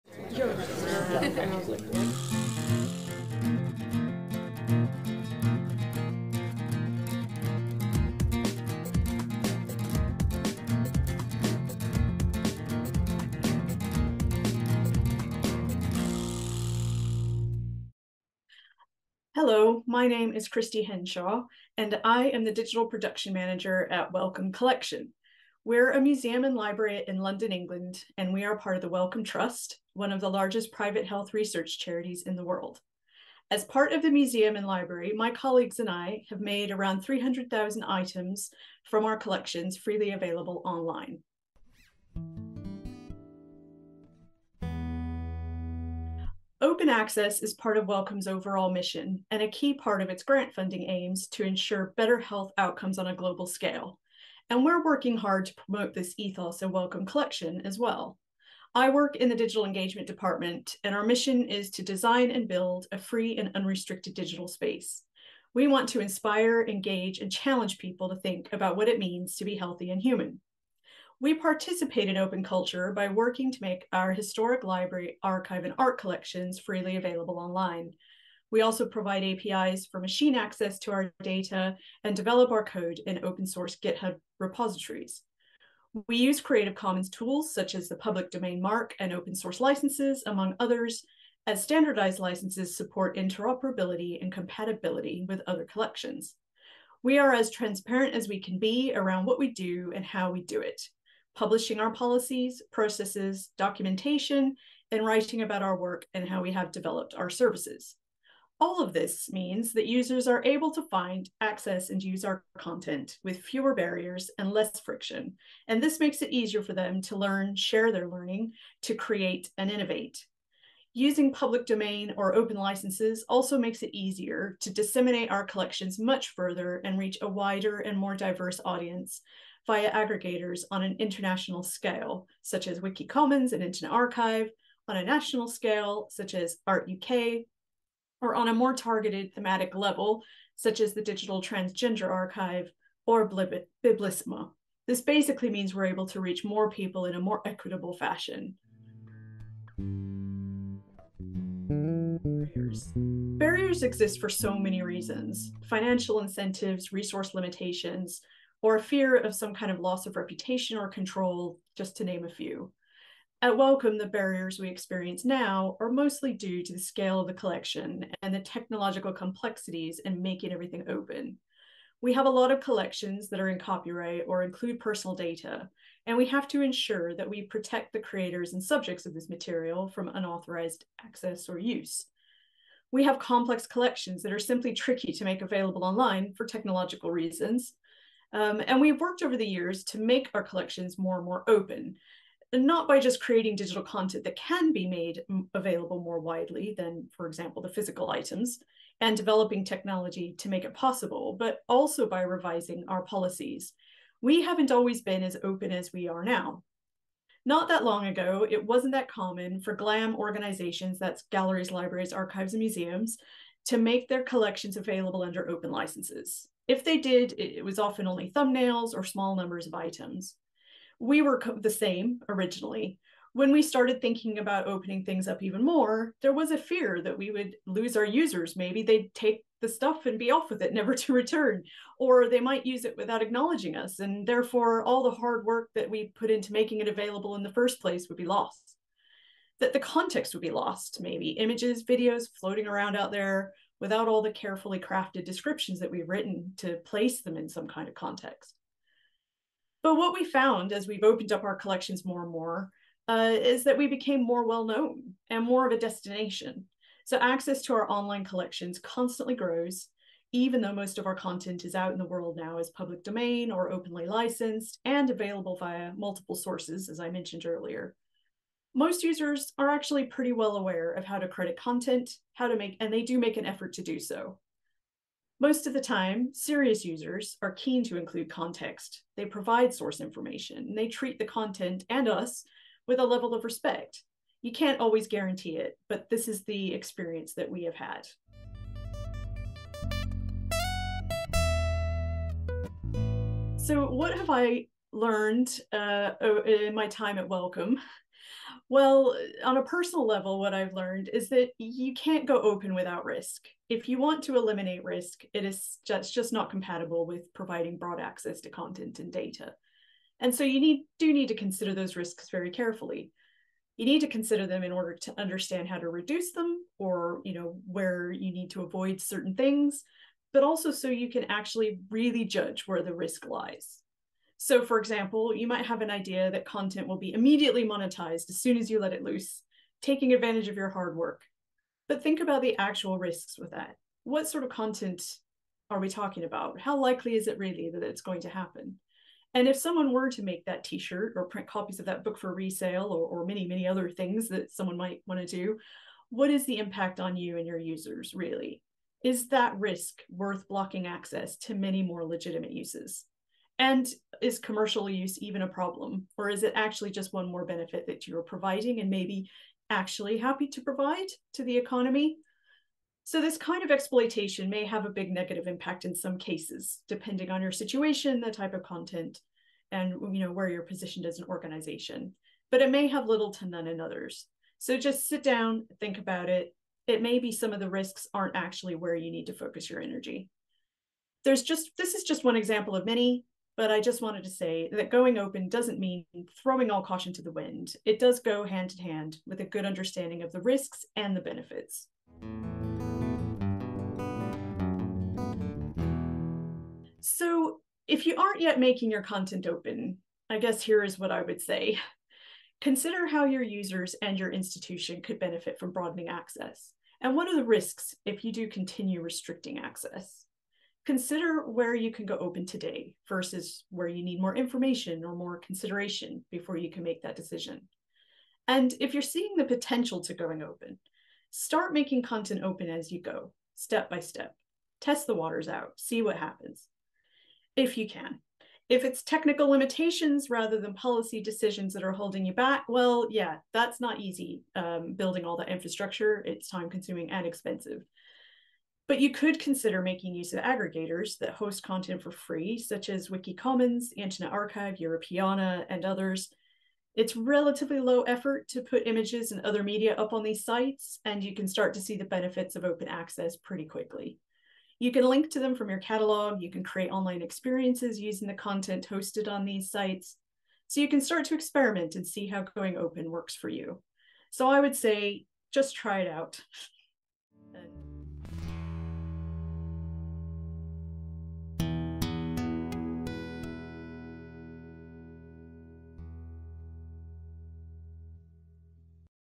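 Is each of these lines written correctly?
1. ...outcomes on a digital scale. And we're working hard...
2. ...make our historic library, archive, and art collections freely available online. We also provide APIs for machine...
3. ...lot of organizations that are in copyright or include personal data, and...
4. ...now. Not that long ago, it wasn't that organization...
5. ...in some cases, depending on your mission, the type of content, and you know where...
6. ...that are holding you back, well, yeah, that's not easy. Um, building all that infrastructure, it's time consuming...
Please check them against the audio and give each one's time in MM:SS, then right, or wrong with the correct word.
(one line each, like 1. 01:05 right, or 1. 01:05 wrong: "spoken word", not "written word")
1. 00:52 wrong: "global", not "digital"
2. 01:13 right
3. 02:52 wrong: "collections", not "organizations"
4. 03:26 wrong: "common", not "organization"
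5. 06:05 wrong: "situation", not "mission"
6. 07:11 right.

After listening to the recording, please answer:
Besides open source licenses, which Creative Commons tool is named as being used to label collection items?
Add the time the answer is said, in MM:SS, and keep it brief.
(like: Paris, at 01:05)
public domain mark, at 01:27.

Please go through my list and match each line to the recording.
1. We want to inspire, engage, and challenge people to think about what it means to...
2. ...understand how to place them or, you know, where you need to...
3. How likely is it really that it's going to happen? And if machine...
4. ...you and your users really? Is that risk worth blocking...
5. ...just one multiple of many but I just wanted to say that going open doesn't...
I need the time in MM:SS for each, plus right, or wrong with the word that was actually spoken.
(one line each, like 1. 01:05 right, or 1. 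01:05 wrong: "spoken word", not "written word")
1. 01:05 right
2. 05:15 wrong: "reduce", not "place"
3. 05:36 wrong: "someone", not "machine"
4. 05:47 right
5. 06:22 wrong: "example", not "multiple".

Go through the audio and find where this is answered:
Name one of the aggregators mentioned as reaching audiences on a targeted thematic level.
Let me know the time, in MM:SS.
02:21.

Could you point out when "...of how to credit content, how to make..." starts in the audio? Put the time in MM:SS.
04:30.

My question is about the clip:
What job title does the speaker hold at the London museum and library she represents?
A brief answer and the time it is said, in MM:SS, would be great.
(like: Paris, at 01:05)
Digital Production Manager, at 00:22.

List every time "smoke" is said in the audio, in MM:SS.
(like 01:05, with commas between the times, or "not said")
not said.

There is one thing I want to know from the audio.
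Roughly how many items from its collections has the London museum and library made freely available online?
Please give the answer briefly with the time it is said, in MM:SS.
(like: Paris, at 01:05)
300,000, at 00:37.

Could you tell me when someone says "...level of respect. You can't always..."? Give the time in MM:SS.
04:43.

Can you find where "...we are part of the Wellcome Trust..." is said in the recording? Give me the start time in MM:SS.
00:28.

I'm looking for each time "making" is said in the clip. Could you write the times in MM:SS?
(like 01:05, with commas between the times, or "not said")
02:50, 03:56, 06:38, 07:01, 07:19.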